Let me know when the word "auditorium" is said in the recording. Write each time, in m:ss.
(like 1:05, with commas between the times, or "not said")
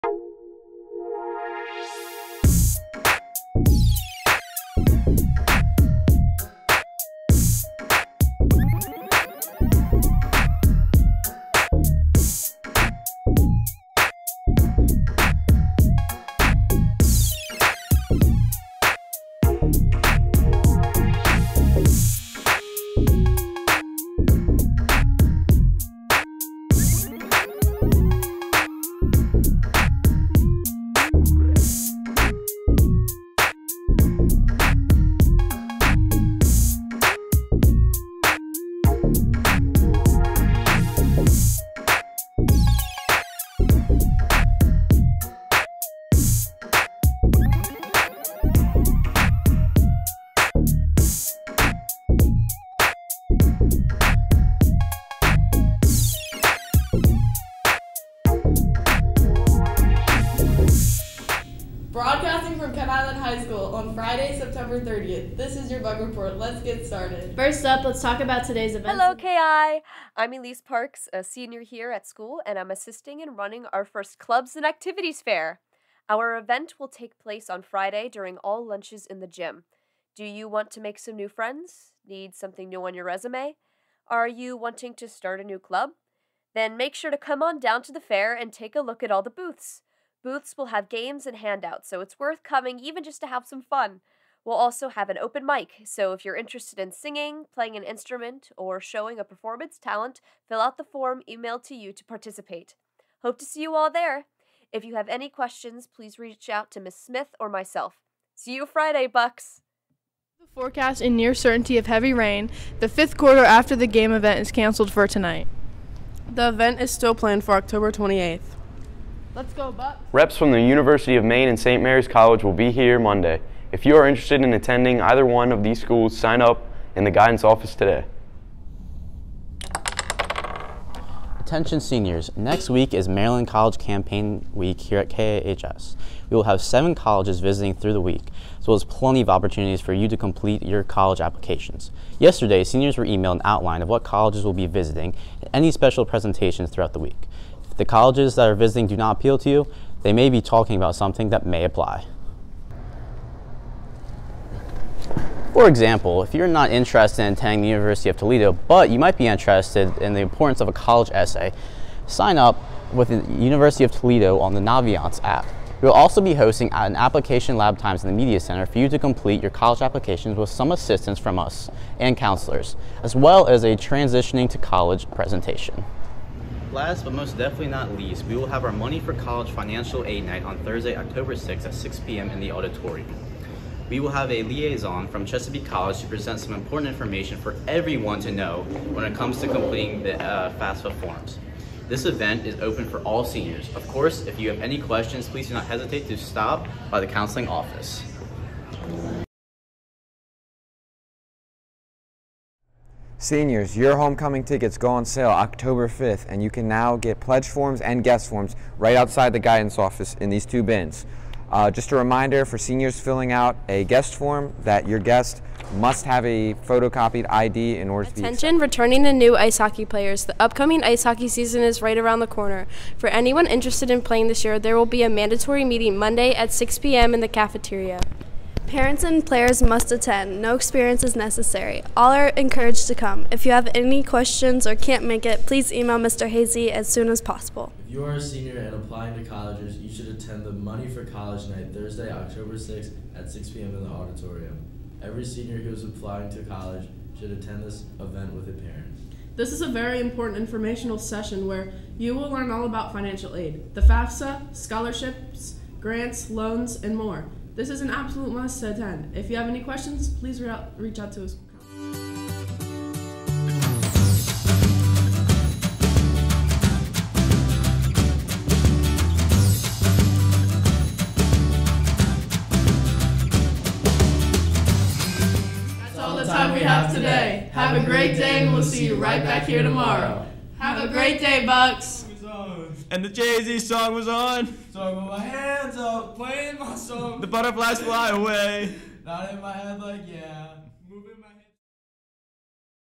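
3:02, 4:03.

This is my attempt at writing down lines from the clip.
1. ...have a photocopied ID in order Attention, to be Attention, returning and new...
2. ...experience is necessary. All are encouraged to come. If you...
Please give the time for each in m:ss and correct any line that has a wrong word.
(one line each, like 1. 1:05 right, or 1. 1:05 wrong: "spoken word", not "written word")
1. 3:36 right
2. 3:50 right.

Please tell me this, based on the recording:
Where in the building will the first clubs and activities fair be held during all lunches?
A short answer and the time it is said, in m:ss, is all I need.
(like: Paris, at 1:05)
The gym, at 1:19.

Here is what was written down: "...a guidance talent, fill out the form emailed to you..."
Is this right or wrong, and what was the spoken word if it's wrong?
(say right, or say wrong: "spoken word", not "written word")
wrong: "performance", not "guidance".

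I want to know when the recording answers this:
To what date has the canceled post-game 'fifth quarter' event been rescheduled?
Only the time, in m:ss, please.
1:57.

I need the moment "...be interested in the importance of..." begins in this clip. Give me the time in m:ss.
2:39.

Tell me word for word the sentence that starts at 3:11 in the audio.
This event is open for all seniors.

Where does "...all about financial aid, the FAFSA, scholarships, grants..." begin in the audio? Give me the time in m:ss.
4:12.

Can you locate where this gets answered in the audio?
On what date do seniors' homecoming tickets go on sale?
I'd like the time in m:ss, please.
3:25.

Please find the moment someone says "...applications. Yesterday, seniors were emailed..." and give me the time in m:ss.
2:21.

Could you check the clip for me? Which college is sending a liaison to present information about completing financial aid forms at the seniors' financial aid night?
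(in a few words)
Chesapeake College.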